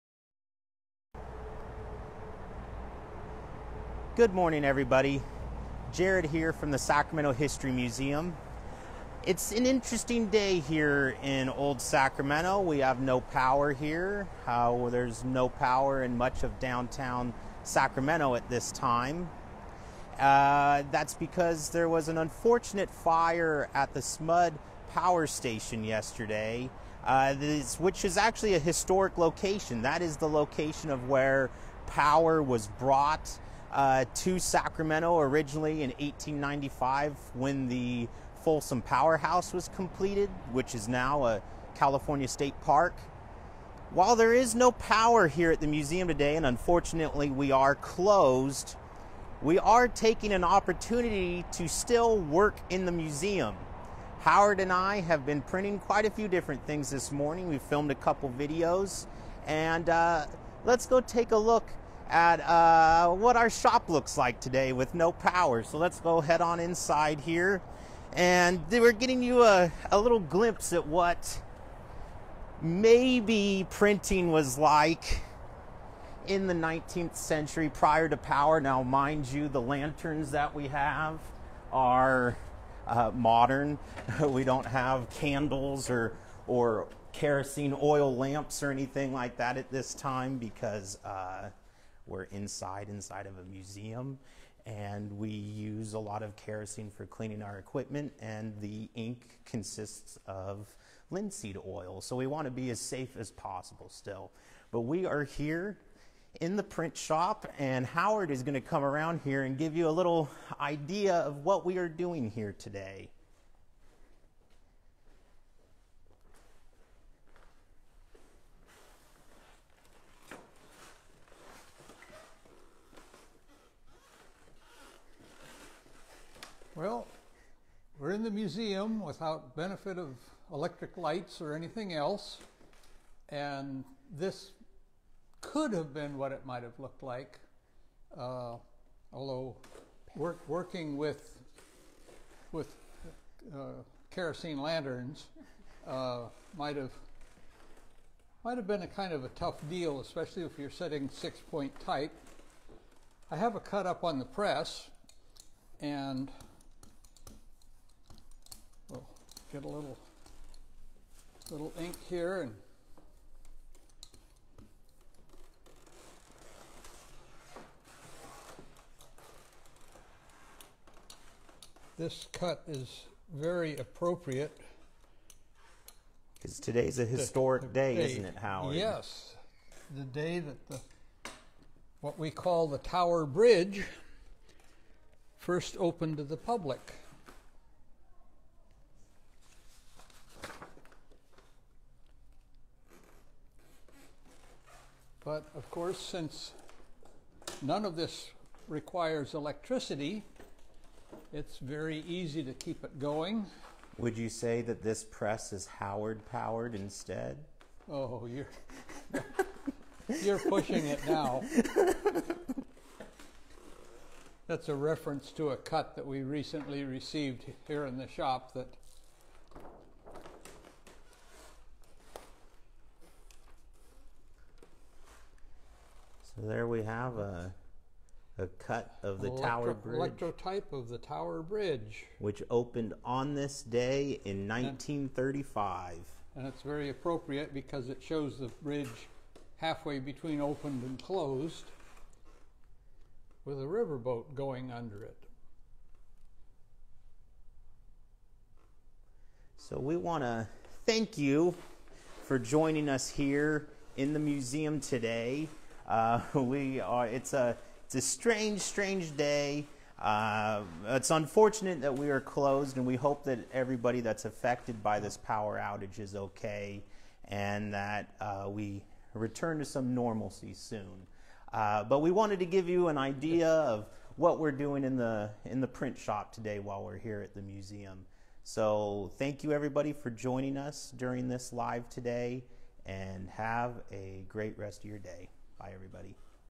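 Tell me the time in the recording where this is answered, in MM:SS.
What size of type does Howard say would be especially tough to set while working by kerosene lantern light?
02:31.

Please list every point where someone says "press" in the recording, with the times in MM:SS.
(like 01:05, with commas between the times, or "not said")
02:34, 03:25.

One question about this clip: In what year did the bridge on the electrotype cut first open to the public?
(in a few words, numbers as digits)
1935.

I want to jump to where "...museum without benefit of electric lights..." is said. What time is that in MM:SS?
02:08.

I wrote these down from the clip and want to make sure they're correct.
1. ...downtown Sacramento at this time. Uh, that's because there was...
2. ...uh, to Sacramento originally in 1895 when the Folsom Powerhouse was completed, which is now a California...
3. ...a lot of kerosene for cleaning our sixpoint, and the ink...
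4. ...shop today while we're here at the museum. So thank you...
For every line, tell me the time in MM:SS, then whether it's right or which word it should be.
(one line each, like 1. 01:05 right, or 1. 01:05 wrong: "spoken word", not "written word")
1. 00:16 right
2. 00:33 right
3. 01:35 wrong: "equipment", not "sixpoint"
4. 04:35 right.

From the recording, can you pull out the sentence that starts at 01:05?
So let's go head on inside here.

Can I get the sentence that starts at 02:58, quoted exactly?
Yes, the day that the what we call the Tower Bridge first opened to the public.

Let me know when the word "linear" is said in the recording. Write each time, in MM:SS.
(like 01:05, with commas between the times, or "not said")
not said.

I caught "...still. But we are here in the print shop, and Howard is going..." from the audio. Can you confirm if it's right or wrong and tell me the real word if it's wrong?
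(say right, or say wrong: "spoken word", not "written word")
right.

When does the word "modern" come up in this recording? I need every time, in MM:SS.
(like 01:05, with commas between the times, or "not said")
01:23.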